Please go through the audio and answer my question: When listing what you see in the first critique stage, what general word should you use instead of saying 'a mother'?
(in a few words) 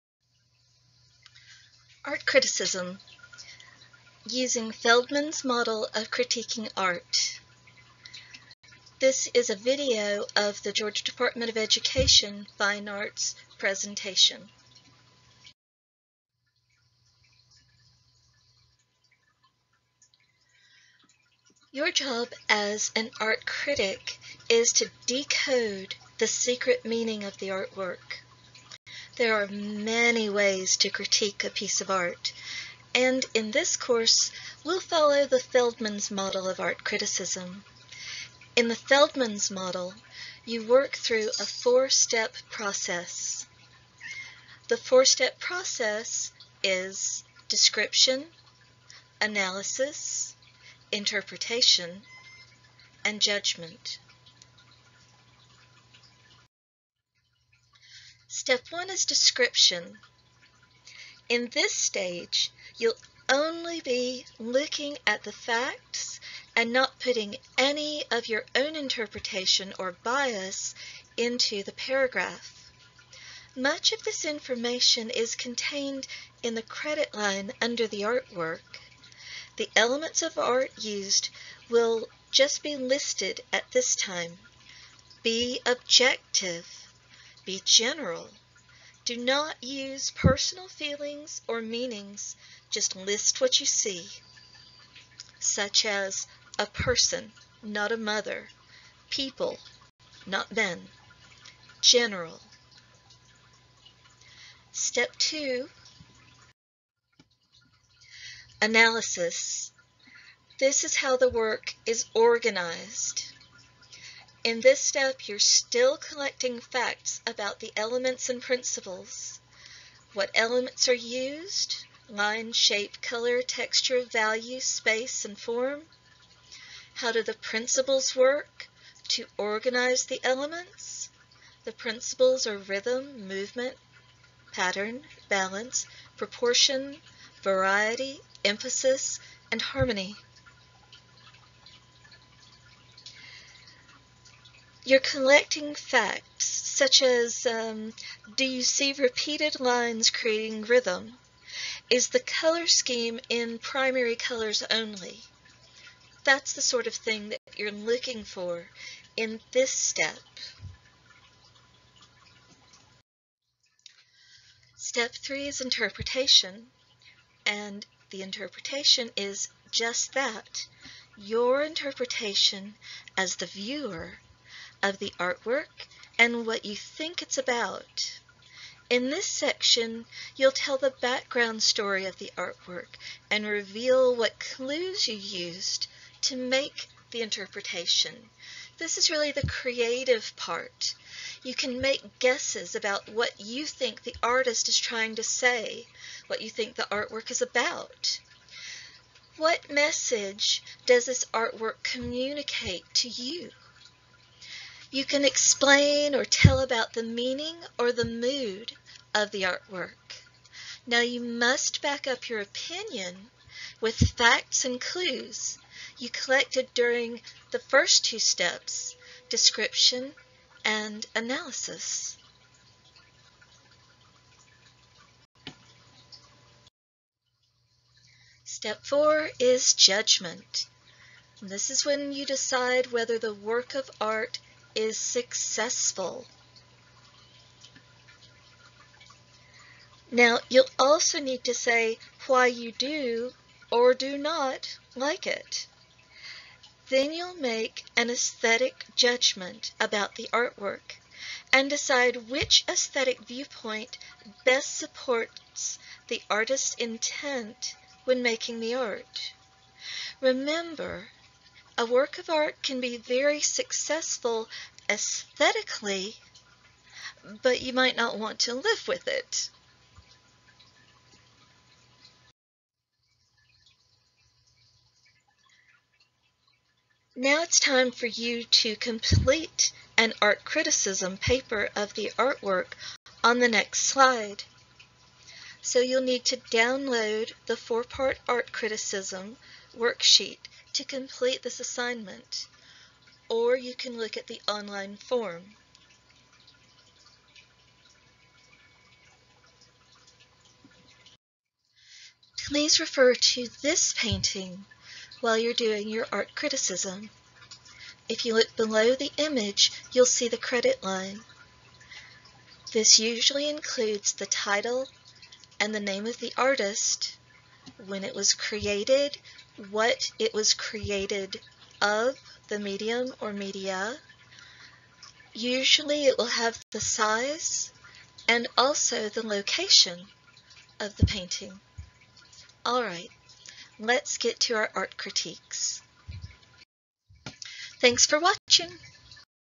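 a person.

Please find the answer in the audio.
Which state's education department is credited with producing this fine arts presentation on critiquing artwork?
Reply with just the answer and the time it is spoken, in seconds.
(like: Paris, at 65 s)
Georgia, at 10 s.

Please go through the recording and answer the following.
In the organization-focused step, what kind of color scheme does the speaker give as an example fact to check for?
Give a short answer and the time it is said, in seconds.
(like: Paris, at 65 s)
primary colors only, at 153 s.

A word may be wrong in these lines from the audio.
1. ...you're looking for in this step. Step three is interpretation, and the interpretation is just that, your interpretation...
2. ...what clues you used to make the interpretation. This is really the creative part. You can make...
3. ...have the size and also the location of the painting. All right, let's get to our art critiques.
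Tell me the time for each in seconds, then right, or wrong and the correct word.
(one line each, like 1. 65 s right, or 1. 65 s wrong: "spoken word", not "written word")
1. 157 s right
2. 184 s right
3. 326 s right.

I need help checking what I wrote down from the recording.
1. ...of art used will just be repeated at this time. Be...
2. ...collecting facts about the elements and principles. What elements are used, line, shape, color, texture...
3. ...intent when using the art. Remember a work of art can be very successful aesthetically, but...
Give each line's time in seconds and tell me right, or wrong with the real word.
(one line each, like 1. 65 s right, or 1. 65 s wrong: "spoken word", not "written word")
1. 80 s wrong: "listed", not "repeated"
2. 115 s right
3. 256 s wrong: "making", not "using".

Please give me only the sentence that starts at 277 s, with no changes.
Now it's time for you to complete an art criticism paper of the artwork on the next slide.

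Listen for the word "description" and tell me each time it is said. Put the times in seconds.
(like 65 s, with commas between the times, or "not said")
47 s, 59 s, 219 s.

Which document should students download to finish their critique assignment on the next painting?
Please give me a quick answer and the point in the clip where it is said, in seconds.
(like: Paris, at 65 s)
four-part art criticism worksheet, at 287 s.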